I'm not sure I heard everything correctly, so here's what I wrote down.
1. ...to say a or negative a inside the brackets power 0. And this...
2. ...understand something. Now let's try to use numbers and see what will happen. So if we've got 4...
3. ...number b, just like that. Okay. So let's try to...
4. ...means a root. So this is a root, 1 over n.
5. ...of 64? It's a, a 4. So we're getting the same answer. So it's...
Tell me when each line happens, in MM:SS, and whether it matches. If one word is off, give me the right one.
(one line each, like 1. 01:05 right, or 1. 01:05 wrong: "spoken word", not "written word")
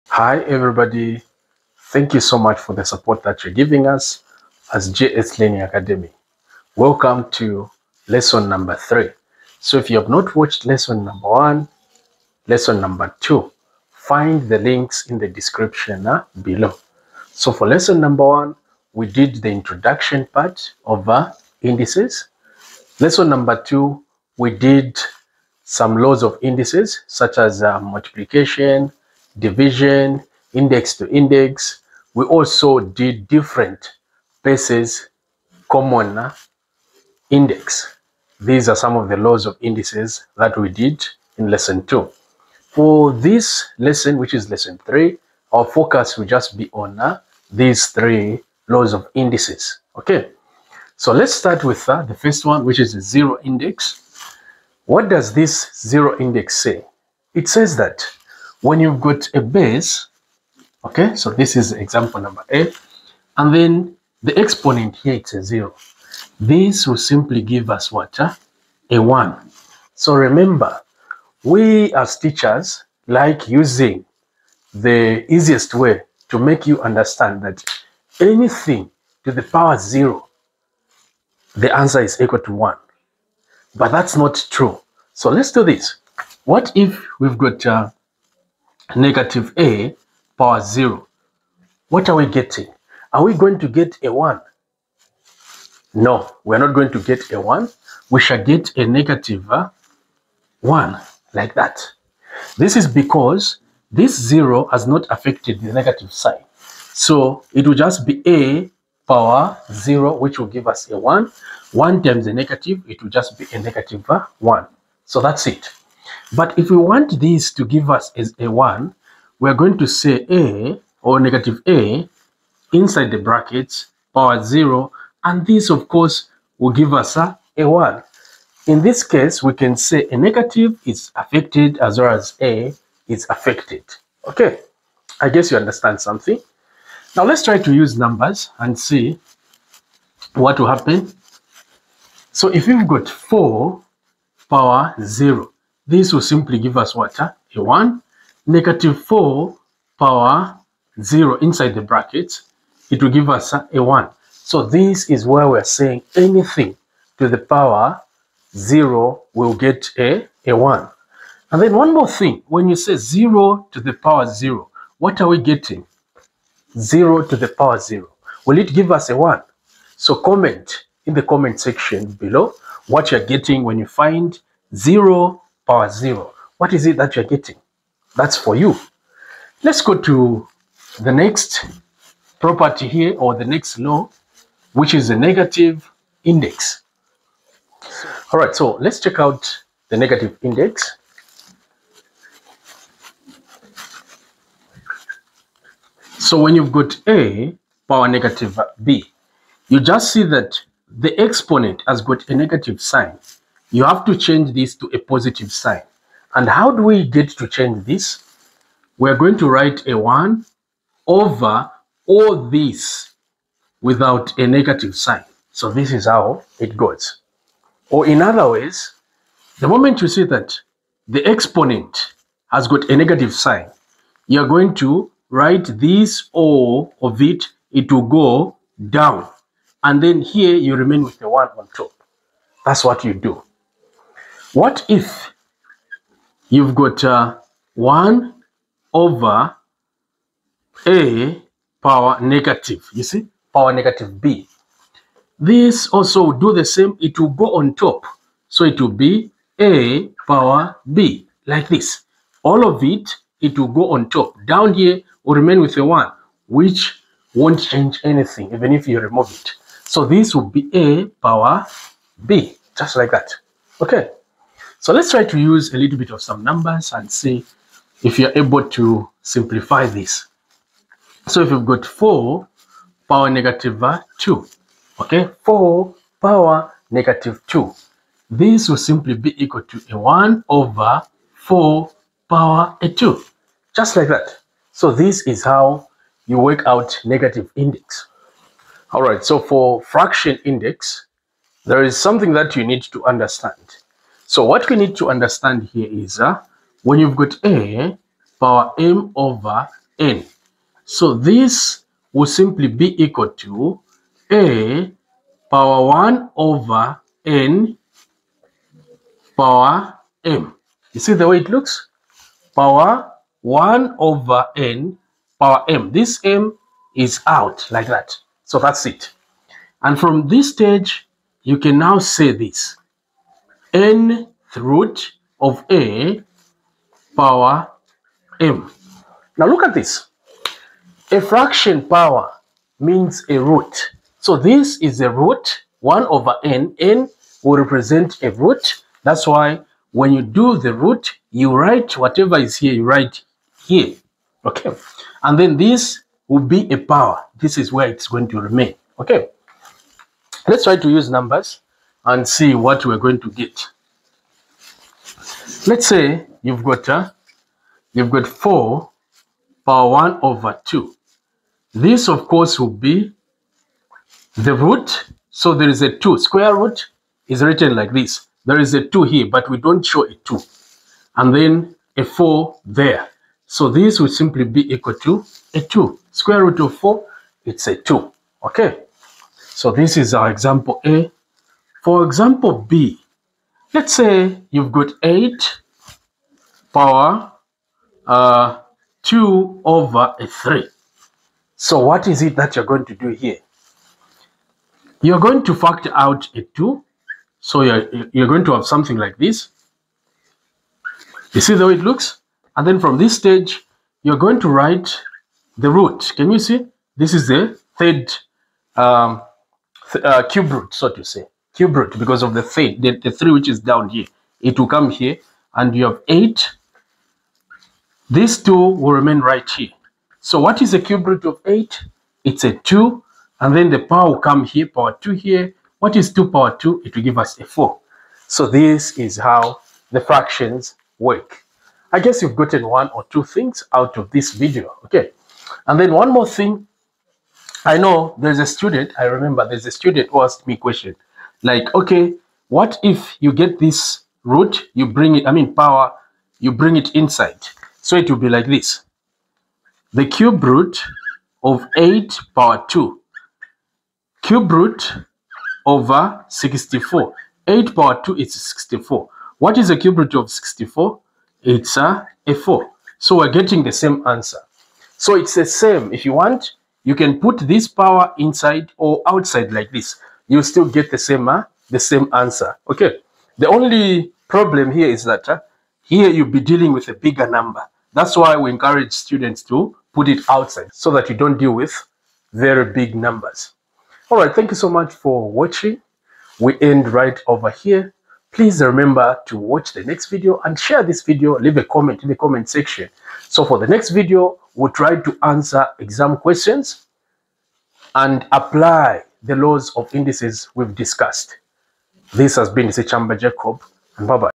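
1. 01:59 right
2. 02:15 right
3. 04:21 wrong: "power", not "number"
4. 05:32 right
5. 07:40 right.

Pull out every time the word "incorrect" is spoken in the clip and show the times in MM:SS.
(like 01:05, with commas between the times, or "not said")
not said.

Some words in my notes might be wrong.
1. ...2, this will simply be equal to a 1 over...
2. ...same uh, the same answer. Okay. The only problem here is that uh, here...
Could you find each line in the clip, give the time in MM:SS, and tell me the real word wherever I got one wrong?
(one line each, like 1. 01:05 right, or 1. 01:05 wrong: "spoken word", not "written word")
1. 04:37 right
2. 07:50 right.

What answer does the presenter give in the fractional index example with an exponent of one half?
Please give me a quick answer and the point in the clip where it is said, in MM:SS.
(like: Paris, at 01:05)
2, at 06:16.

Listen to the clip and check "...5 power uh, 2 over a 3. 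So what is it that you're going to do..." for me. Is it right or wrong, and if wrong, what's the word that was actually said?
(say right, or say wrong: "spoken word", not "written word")
wrong: "8", not "5".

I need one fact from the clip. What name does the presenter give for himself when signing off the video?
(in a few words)
Sichamba Jacob.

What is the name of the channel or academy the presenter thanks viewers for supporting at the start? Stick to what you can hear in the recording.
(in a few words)
JS Learning Academy.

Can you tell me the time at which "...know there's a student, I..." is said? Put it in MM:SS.
07:17.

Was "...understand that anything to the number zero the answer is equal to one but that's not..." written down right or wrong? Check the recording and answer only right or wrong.
wrong.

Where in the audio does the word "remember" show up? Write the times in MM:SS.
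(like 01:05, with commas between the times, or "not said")
01:10, 07:19, 08:08.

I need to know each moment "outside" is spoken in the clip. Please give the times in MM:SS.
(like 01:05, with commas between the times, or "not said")
07:49, 08:00.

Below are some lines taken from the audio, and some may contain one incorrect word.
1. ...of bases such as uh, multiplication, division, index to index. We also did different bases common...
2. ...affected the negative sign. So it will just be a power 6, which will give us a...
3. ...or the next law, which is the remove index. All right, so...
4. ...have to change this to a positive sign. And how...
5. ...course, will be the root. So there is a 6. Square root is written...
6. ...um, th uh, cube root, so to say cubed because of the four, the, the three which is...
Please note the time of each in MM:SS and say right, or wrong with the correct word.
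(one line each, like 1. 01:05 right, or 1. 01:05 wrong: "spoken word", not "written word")
1. 00:26 wrong: "indices", not "bases"
2. 01:45 wrong: "0", not "6"
3. 03:03 wrong: "negative", not "remove"
4. 03:23 right
5. 06:02 wrong: "2", not "6"
6. 06:48 wrong: "three", not "four".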